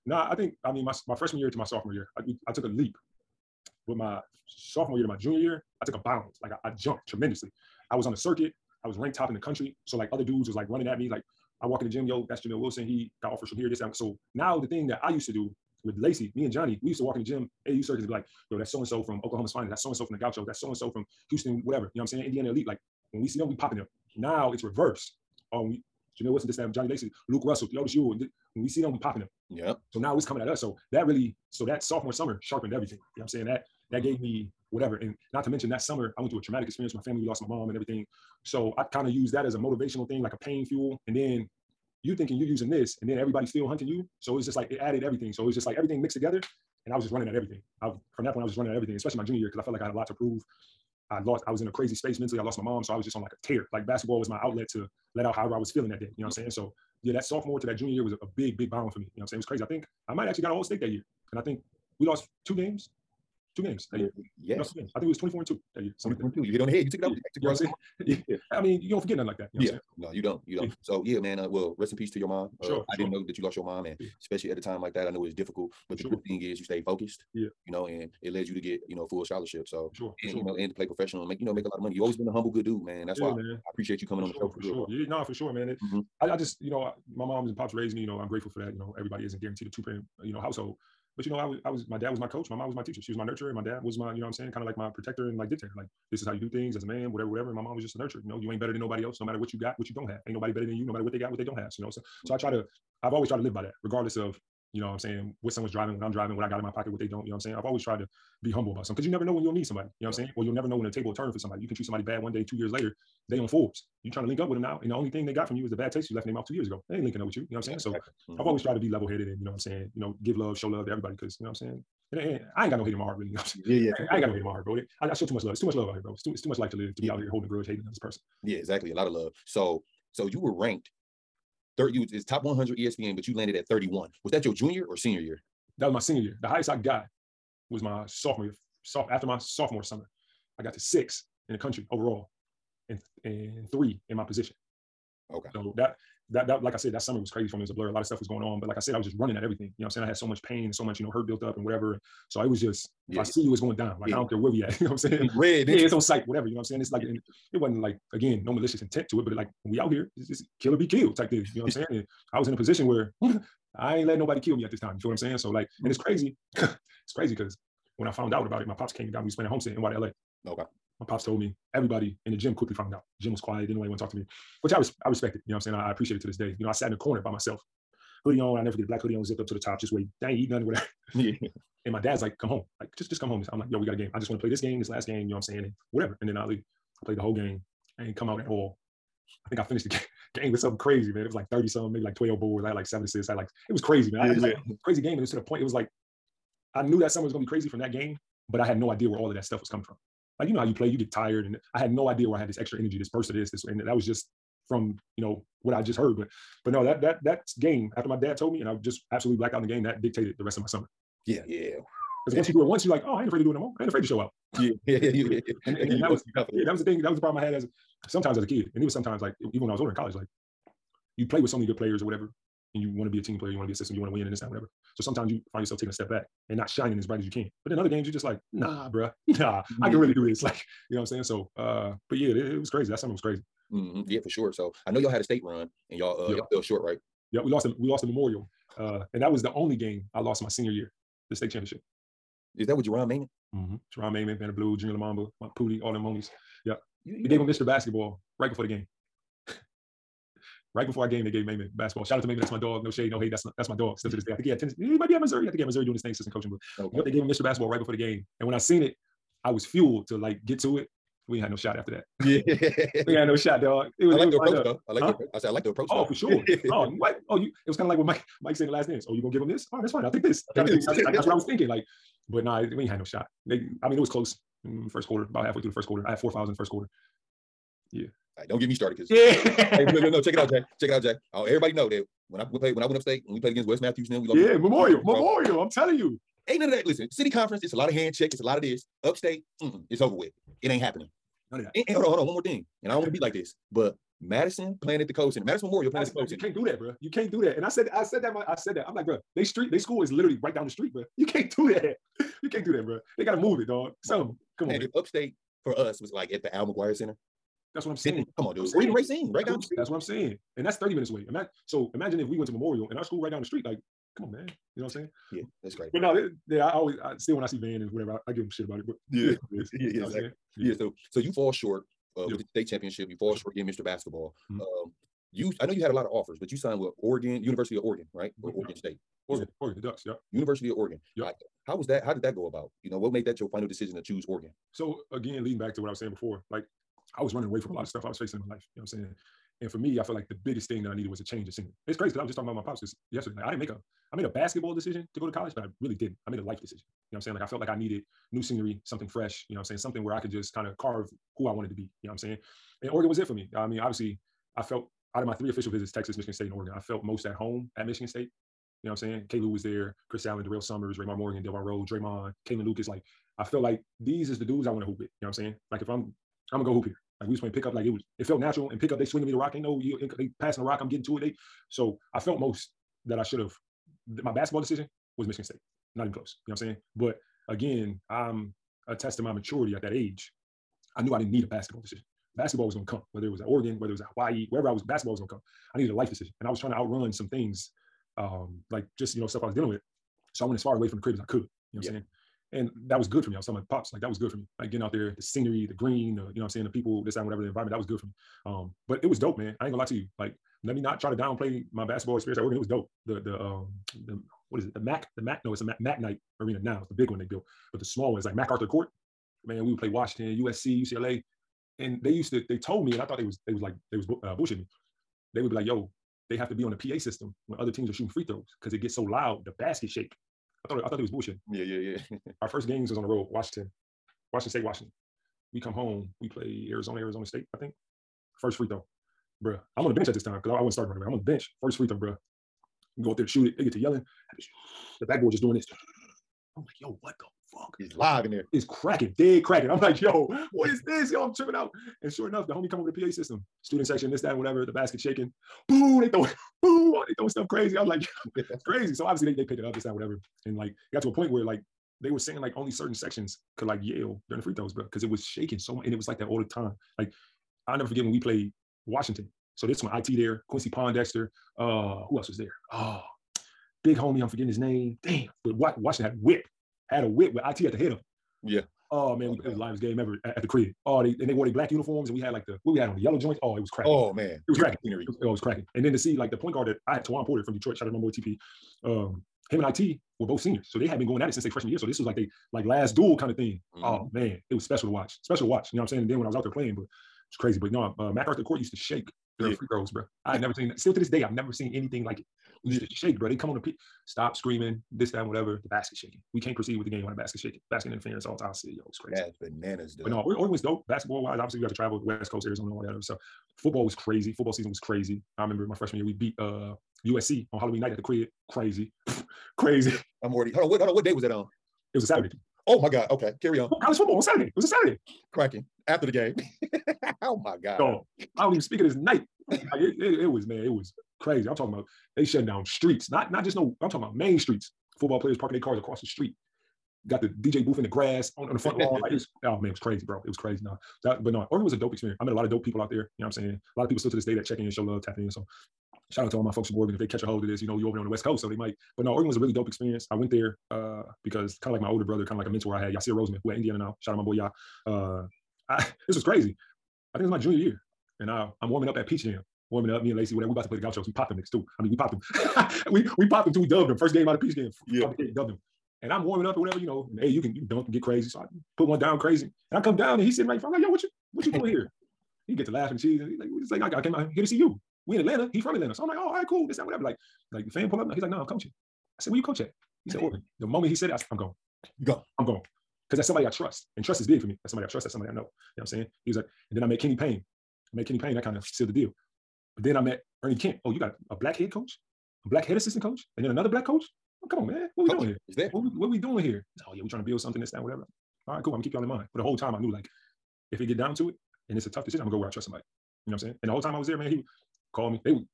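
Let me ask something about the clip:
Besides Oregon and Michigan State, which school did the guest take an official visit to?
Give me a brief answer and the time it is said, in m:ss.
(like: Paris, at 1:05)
Texas, at 5:55.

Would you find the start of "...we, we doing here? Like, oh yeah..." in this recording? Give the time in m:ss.
9:46.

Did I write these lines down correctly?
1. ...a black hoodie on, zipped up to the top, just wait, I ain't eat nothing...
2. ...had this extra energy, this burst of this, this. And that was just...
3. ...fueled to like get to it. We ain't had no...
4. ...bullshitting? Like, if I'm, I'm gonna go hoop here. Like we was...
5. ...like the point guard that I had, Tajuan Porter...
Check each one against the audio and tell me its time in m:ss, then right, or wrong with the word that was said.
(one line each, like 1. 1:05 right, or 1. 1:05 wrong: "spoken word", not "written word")
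1. 2:58 right
2. 3:22 right
3. 4:19 right
4. 6:05 wrong: "saying", not "bullshitting"
5. 7:56 right.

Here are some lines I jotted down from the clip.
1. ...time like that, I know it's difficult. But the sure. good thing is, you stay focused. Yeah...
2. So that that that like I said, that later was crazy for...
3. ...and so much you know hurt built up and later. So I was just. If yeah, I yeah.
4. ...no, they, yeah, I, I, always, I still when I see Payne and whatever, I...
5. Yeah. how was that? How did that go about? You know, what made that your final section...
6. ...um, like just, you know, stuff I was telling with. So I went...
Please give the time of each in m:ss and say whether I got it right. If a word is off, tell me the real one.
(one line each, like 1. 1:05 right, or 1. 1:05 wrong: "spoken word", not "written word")
1. 1:14 right
2. 2:25 wrong: "summer", not "later"
3. 2:30 wrong: "whatever", not "later"
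4. 5:16 wrong: "Van", not "Payne"
5. 5:31 wrong: "decision", not "section"
6. 6:28 wrong: "dealing", not "telling".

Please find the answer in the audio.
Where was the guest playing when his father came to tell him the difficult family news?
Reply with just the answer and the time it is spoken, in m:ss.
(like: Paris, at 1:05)
Homestead, at 2:49.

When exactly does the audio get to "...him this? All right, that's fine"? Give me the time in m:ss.
4:29.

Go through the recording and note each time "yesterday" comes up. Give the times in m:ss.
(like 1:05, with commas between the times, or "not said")
5:43.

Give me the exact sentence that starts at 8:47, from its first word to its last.
Got the DJ booth in the grass on, on the front lawn.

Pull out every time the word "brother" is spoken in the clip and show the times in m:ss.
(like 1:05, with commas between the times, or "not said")
9:02.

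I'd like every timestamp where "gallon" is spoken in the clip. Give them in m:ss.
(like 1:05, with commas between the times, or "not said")
not said.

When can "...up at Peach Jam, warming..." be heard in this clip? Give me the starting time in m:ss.
9:08.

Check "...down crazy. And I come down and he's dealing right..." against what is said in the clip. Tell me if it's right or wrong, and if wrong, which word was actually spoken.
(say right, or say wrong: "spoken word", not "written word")
wrong: "sitting", not "dealing".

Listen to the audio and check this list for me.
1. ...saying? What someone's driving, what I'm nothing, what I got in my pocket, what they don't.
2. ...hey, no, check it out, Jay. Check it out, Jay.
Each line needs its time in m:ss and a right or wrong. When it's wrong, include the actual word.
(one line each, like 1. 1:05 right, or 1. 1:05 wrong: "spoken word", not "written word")
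1. 1:44 wrong: "driving", not "nothing"
2. 4:39 right.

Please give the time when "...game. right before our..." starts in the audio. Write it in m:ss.
4:08.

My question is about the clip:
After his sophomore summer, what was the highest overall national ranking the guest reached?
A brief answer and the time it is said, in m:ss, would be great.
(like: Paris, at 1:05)
6, at 2:20.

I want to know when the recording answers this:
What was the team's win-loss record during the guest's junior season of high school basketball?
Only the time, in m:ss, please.
1:05.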